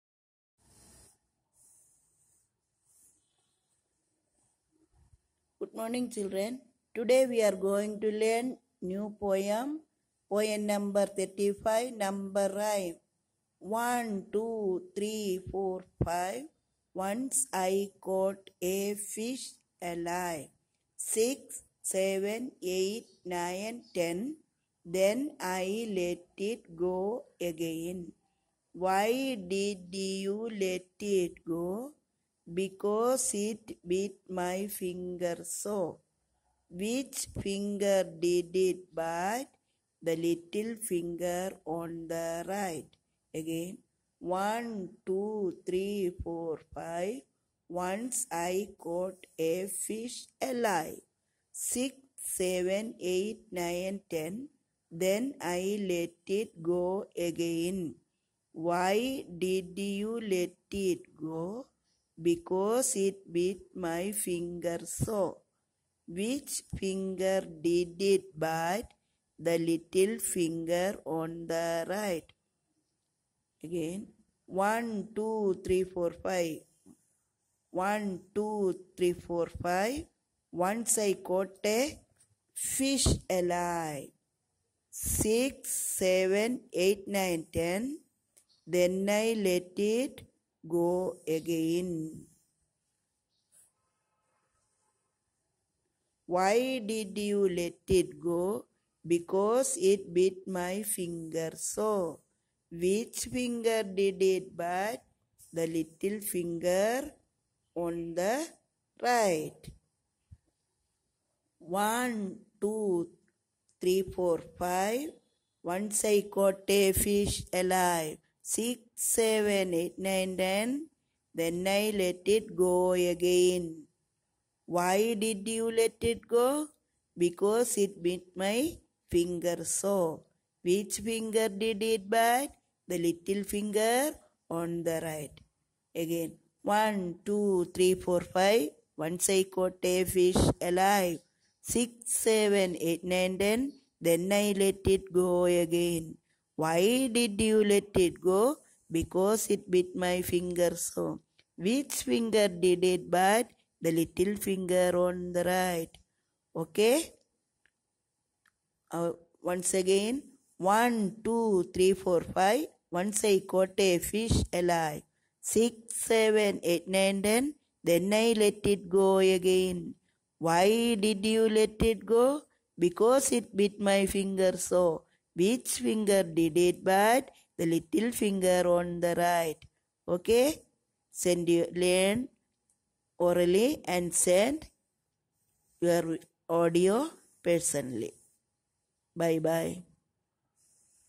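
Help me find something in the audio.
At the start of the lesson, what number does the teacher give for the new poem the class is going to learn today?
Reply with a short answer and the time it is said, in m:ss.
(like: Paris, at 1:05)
35, at 0:11.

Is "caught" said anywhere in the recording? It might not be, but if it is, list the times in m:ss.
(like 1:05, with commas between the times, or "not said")
0:18, 0:48, 1:21, 1:56, 2:19, 2:43.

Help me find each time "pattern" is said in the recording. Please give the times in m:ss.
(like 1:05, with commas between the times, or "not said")
not said.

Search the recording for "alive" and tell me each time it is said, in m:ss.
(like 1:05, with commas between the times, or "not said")
0:19, 0:50, 1:23, 1:57, 2:20, 2:44.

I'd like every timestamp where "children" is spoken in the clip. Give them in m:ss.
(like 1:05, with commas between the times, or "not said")
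0:06.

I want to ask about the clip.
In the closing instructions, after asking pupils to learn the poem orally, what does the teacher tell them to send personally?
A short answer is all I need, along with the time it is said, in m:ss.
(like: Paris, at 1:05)
your audio, at 3:05.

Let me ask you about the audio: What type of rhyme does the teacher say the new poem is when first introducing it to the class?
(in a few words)
number rhyme.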